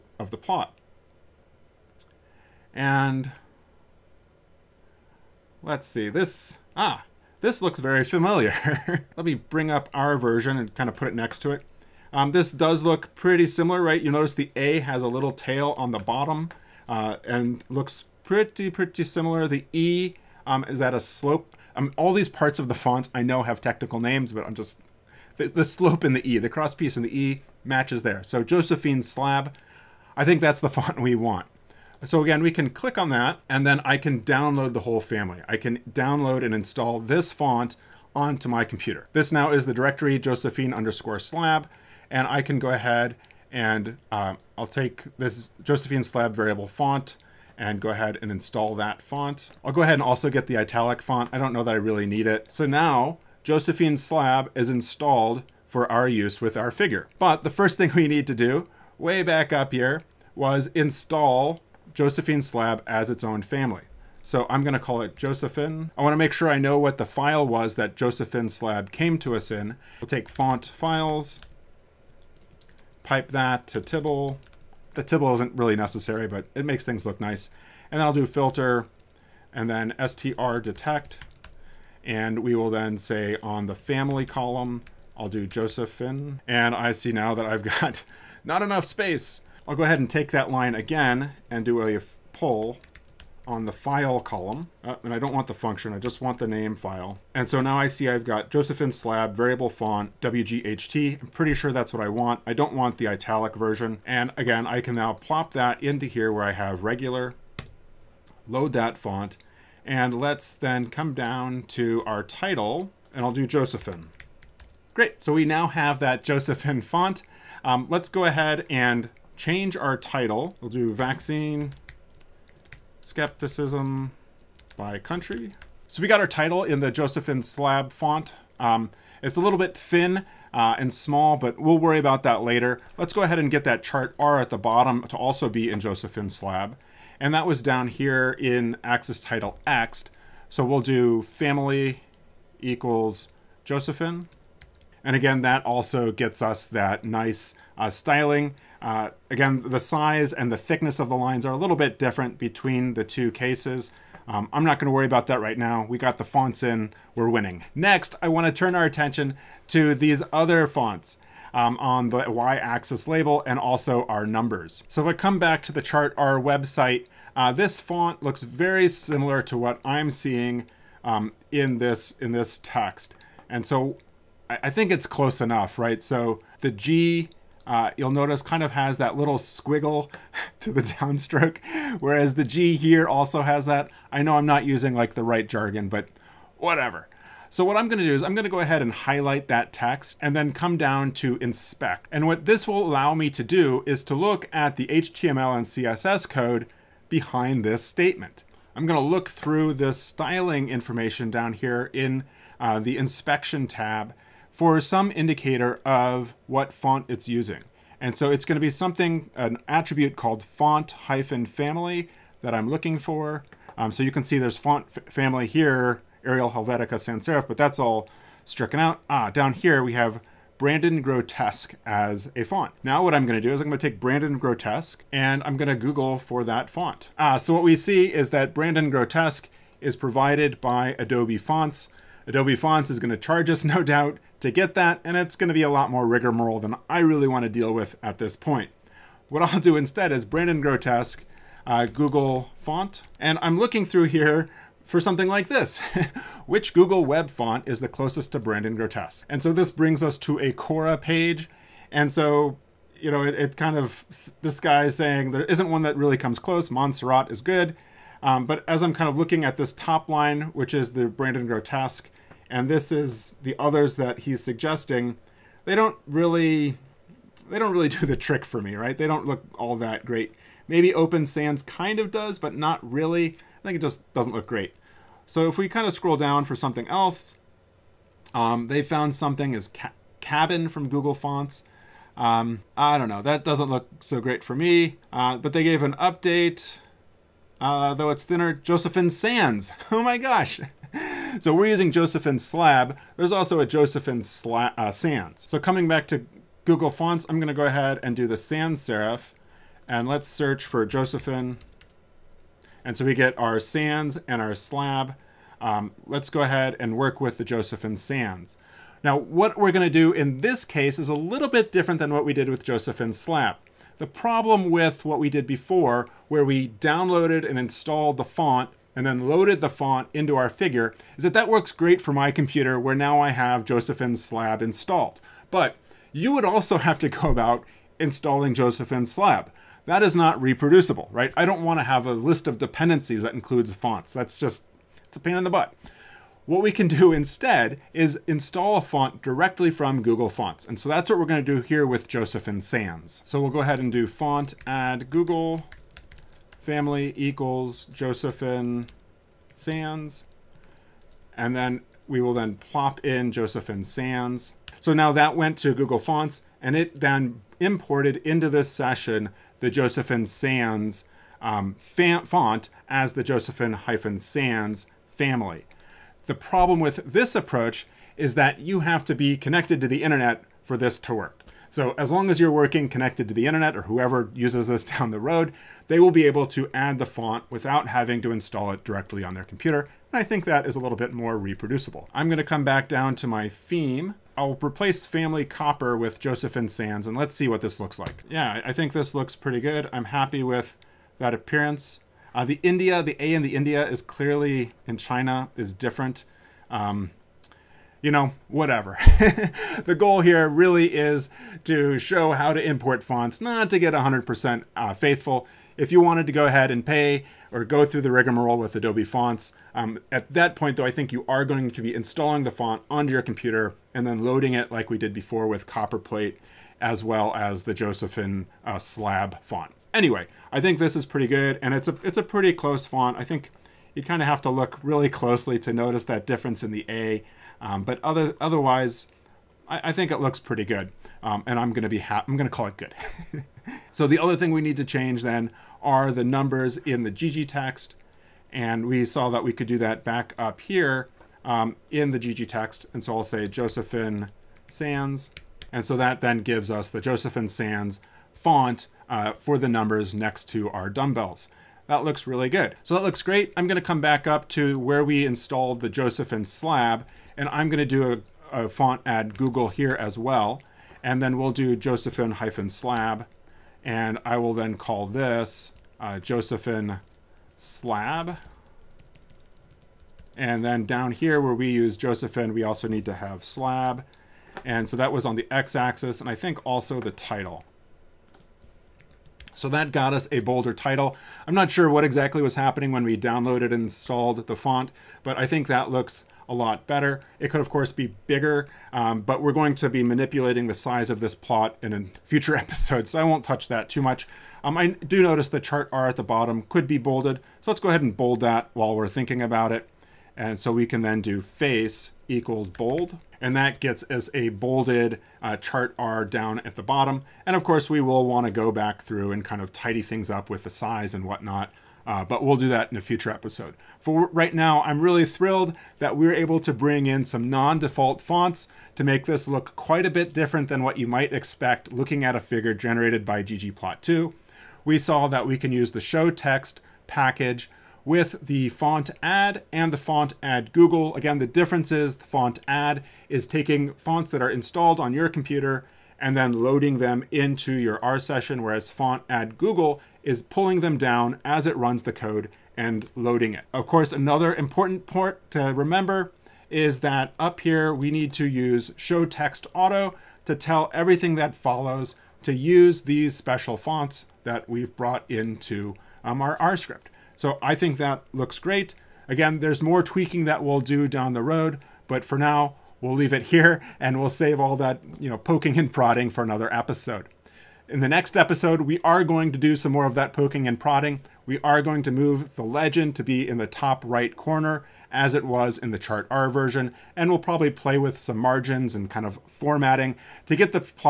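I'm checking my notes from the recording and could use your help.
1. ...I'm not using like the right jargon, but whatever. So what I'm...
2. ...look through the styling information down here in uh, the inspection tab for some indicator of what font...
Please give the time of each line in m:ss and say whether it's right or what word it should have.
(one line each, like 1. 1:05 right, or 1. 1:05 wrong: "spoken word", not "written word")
1. 3:04 right
2. 3:18 right.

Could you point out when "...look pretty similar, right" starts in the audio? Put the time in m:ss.
0:12.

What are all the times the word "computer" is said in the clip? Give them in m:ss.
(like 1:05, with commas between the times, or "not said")
0:38, 5:22, 6:19, 6:53, 8:55.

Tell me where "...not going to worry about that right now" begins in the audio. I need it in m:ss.
2:34.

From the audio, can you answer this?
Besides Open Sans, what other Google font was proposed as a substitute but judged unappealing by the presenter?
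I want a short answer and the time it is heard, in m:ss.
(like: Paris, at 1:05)
Cabin, at 4:40.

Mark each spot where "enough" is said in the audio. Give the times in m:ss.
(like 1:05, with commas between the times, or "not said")
1:28, 2:55.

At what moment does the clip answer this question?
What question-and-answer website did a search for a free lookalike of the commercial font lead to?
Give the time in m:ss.
4:10.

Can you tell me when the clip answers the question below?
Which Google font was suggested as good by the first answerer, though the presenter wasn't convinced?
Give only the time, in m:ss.
4:16.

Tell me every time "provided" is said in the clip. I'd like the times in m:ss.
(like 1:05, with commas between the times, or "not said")
3:49.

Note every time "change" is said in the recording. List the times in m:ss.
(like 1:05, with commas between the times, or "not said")
1:59, 7:14.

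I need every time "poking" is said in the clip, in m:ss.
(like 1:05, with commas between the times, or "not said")
9:25, 9:30.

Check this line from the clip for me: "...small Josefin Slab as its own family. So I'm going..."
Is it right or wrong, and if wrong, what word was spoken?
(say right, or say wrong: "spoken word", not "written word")
wrong: "install", not "small".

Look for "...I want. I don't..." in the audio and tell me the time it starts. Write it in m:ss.
1:42.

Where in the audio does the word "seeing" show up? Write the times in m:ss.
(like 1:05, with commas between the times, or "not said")
2:50.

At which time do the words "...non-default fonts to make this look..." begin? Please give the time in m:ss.
8:37.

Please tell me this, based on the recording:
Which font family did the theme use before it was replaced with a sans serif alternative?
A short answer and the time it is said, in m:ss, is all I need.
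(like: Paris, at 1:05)
Copper, at 6:25.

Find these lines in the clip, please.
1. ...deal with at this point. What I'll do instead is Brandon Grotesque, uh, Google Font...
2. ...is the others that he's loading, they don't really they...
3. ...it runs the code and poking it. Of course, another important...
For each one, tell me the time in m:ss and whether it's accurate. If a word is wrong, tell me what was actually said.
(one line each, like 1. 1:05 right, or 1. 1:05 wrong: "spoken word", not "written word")
1. 3:57 right
2. 4:22 wrong: "suggesting", not "loading"
3. 9:01 wrong: "loading", not "poking".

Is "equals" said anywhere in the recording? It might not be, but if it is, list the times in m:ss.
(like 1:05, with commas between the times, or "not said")
2:22, 5:47, 8:22.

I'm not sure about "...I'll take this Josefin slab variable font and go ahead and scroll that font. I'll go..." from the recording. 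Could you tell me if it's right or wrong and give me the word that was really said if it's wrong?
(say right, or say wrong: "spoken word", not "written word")
wrong: "install", not "scroll".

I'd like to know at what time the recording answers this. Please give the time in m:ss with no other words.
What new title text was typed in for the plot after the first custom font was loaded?
2:00.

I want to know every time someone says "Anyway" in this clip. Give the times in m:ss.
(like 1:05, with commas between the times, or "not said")
6:59.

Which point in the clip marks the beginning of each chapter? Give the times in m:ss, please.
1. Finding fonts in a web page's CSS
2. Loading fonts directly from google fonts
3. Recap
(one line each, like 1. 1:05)
1. 2:37
2. 5:08
3. 8:33.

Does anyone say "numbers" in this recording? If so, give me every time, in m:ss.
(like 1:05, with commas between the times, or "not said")
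2:44, 7:16, 7:29.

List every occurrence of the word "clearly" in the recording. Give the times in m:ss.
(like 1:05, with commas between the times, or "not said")
6:34.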